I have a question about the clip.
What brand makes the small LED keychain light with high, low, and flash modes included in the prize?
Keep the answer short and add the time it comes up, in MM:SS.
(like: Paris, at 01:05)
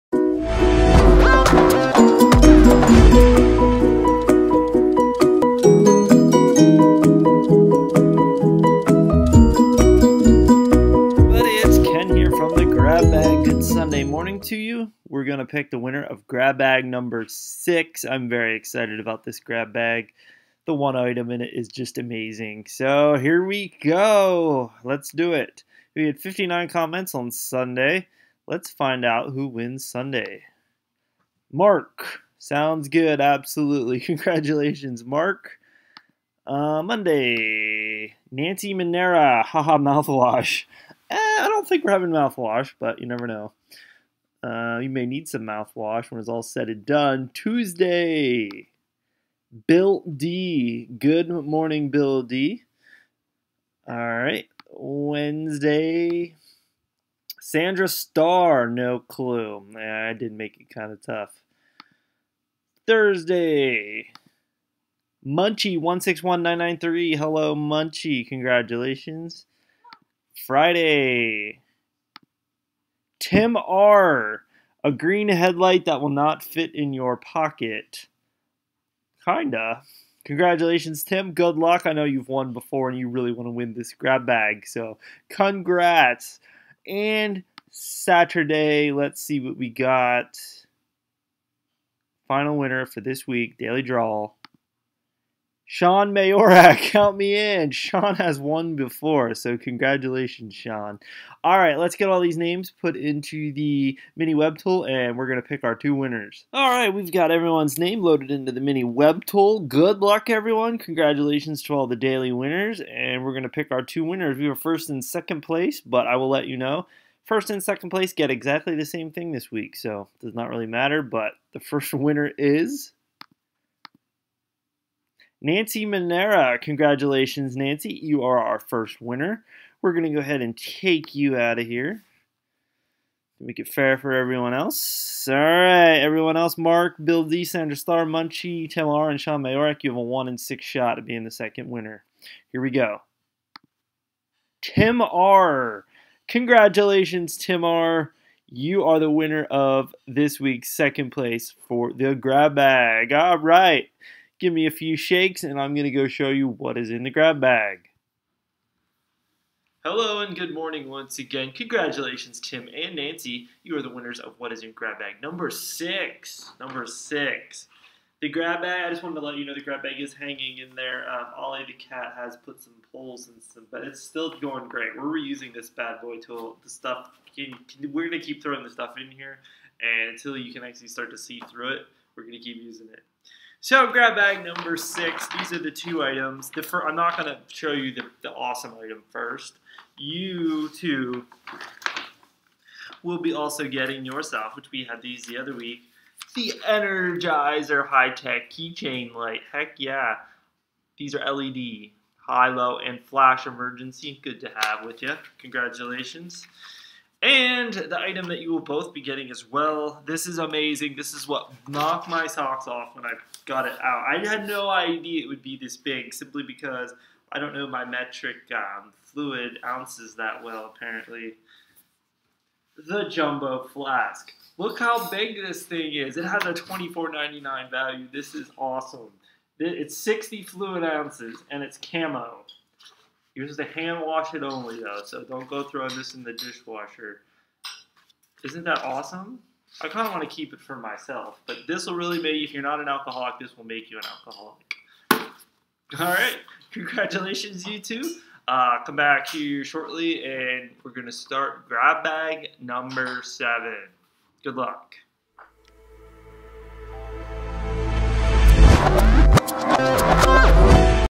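Energizer, at 03:16.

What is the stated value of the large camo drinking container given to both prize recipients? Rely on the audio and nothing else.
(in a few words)
$24.99.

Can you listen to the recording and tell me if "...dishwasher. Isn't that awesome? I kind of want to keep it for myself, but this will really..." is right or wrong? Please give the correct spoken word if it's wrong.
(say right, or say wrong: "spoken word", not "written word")
right.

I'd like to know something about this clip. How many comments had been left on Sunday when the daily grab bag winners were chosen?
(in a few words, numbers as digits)
59.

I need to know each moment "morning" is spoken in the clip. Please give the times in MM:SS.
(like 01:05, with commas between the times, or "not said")
00:51, 02:40.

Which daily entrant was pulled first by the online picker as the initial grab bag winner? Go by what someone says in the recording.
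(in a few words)
Nancy Monera.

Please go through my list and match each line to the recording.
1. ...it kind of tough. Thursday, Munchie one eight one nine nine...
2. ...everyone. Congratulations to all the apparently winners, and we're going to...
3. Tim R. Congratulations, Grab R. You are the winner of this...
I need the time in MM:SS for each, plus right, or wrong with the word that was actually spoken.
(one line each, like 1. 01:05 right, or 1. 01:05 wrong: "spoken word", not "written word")
1. 01:00 wrong: "six", not "eight"
2. 01:50 wrong: "daily", not "apparently"
3. 02:24 wrong: "Tim", not "Grab".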